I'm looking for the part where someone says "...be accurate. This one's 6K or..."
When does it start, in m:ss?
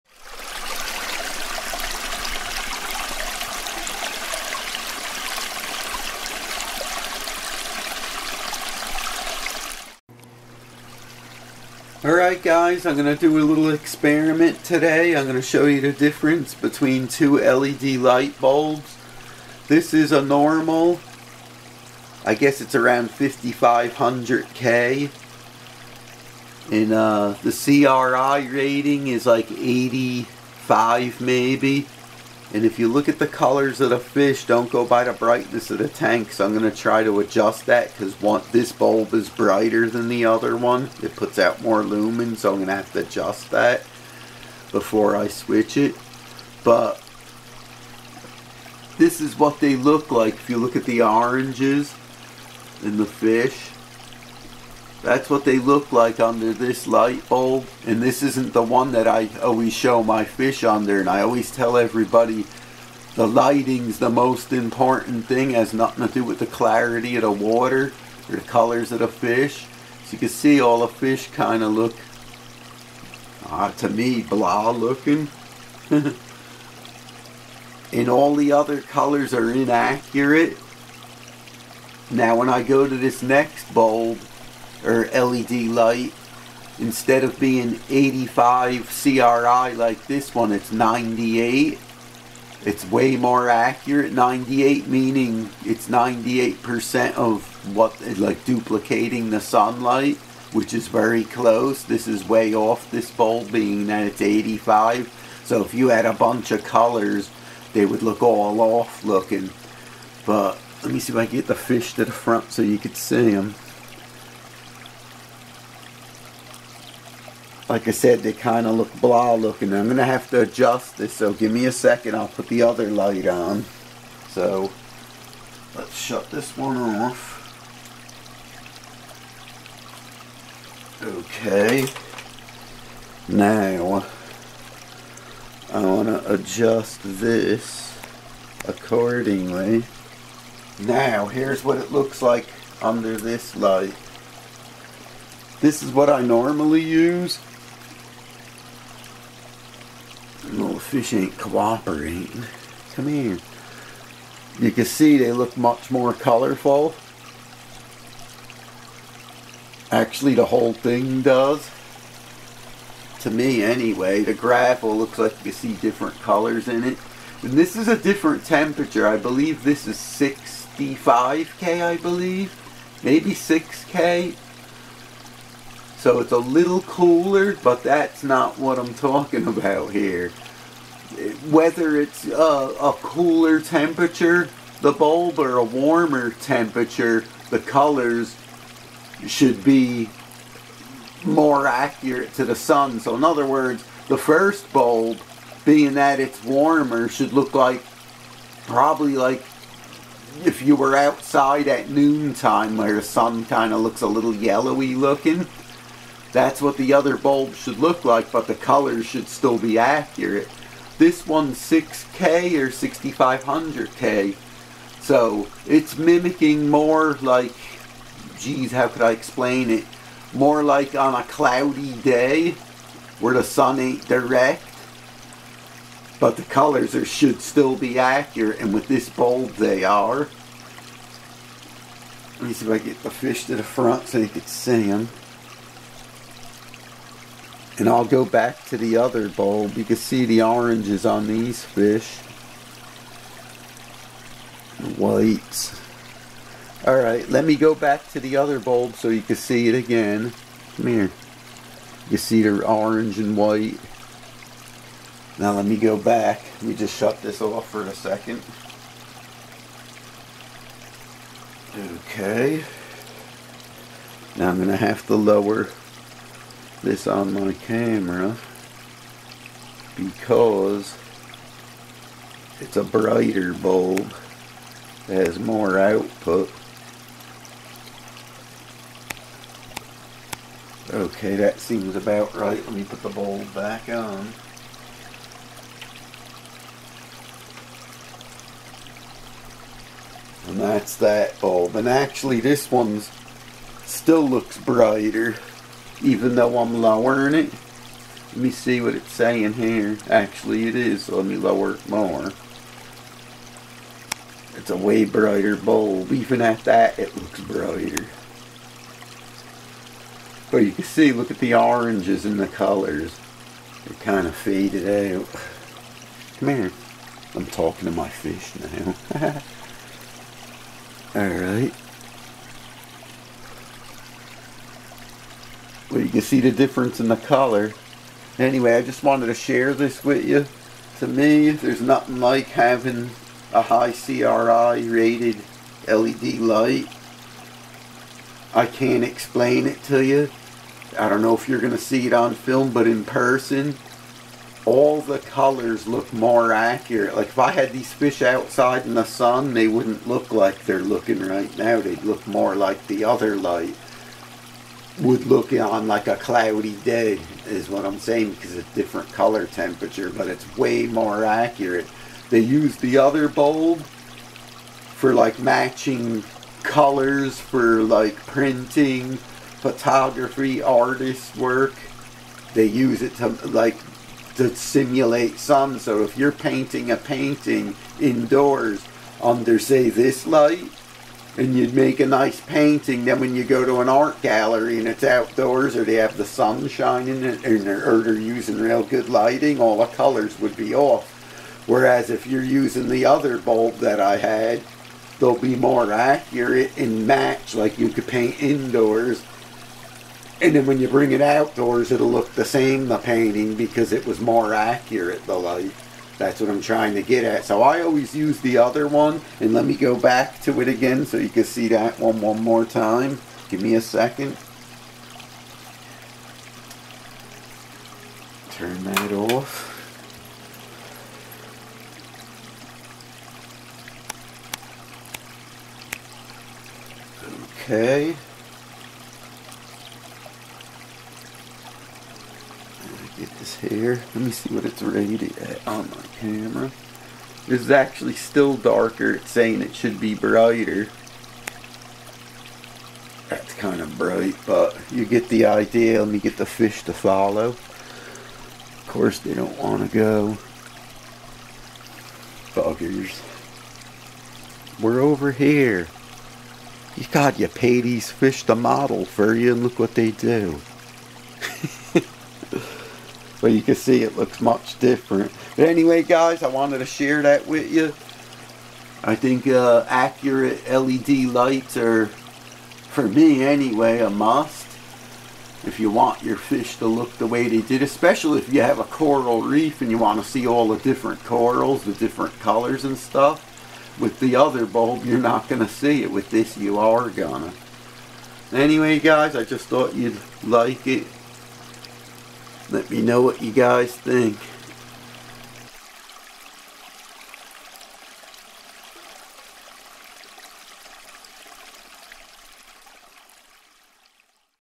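3:29.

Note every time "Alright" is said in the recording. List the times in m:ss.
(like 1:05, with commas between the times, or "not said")
0:12, 4:06, 5:21.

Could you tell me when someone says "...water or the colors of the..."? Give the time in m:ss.
1:07.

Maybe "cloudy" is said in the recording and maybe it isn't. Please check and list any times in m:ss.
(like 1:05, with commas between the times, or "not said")
3:41, 5:56.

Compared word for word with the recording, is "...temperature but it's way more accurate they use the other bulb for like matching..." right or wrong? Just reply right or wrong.
right.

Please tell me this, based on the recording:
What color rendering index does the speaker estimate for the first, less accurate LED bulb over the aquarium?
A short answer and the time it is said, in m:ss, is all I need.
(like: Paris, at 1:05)
85, at 0:29.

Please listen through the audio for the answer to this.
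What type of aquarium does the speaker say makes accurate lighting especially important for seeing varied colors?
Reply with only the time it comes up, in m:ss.
7:58.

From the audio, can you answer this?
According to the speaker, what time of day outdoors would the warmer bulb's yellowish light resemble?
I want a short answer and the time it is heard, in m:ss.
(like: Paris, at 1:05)
noontime, at 3:21.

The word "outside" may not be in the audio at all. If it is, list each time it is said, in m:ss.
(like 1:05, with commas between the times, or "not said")
3:20, 5:48.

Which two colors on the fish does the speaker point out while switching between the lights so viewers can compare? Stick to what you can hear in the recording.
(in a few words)
orange and white.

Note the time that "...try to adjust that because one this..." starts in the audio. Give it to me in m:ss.
0:36.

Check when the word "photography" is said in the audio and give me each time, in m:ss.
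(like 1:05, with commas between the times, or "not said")
6:09.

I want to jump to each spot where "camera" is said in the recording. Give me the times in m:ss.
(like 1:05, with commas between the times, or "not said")
4:27, 7:16.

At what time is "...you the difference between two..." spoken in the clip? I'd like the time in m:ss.
0:15.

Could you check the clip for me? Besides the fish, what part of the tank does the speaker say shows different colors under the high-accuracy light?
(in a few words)
gravel.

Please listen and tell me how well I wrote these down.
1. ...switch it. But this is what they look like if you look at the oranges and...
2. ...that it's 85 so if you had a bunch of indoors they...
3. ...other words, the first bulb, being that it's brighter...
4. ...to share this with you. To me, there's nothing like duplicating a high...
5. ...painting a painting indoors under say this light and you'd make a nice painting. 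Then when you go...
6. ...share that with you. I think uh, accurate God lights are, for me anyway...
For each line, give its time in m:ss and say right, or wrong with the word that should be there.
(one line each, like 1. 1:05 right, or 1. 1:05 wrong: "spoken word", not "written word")
1. 0:45 right
2. 1:43 wrong: "colors", not "indoors"
3. 3:13 wrong: "warmer", not "brighter"
4. 5:29 wrong: "having", not "duplicating"
5. 6:16 right
6. 7:46 wrong: "LED", not "God".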